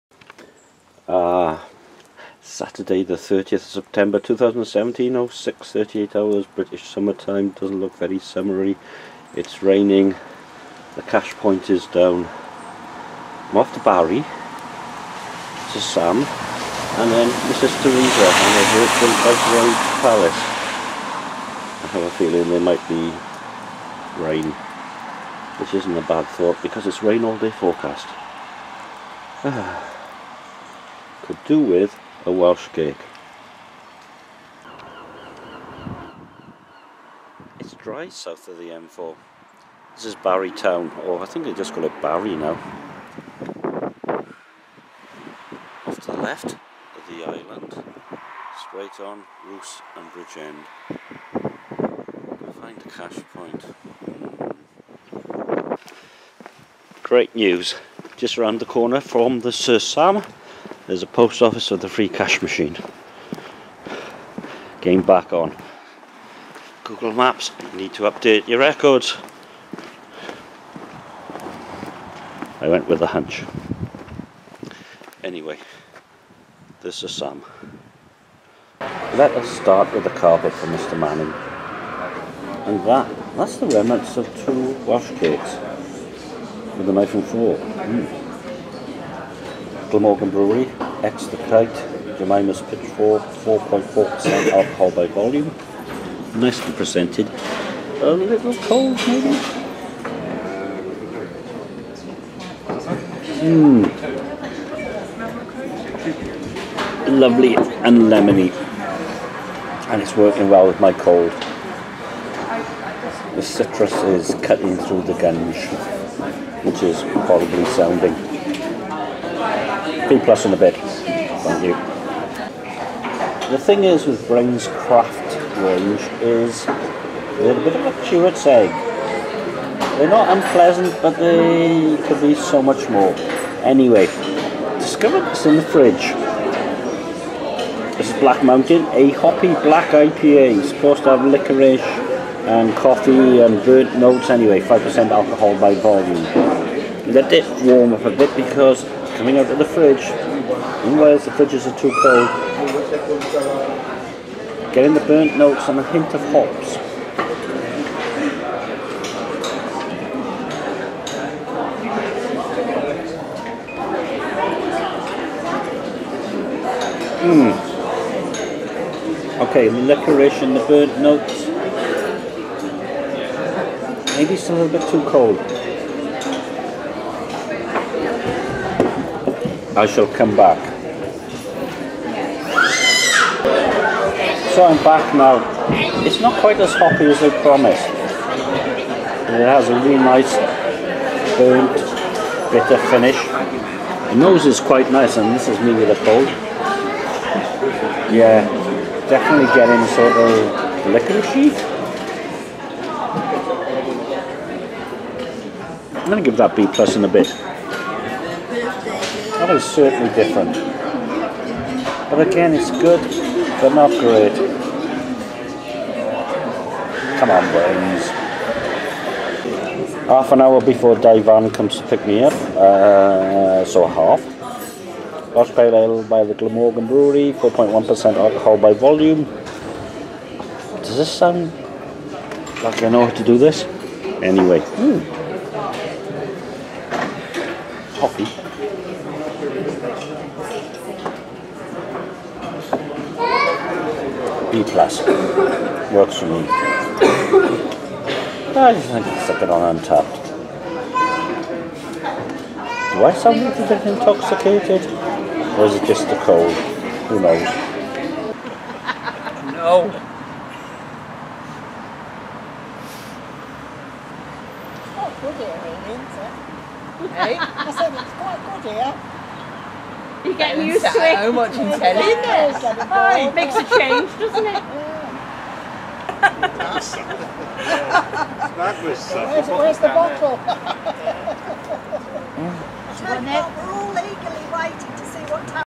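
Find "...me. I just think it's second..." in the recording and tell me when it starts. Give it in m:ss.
4:06.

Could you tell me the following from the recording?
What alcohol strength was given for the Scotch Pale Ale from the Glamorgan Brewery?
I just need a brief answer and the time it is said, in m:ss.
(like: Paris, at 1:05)
4.1%, at 3:47.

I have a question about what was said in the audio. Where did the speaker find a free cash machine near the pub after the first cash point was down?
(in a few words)
post office.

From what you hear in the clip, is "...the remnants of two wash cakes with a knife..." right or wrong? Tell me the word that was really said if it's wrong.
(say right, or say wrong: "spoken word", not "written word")
right.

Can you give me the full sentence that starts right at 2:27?
Let it warm up a bit because coming out of the fridge.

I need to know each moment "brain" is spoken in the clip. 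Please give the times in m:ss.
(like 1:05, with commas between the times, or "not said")
2:04, 3:37.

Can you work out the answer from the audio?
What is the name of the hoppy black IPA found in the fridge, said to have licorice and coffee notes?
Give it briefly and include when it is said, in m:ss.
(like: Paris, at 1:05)
Black Mountain, at 2:18.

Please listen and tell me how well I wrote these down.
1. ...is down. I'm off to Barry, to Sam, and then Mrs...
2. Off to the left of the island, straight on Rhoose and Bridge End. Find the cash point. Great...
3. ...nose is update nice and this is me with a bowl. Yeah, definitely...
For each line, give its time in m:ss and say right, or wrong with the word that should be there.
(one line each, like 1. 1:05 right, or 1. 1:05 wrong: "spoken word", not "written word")
1. 0:11 right
2. 0:45 right
3. 3:14 wrong: "quite", not "update".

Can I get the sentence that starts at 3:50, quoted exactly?
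Does this sound like I know how to do this?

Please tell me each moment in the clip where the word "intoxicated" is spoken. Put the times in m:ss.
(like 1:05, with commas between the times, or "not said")
4:13.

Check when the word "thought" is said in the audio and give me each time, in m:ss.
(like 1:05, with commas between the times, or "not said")
0:26.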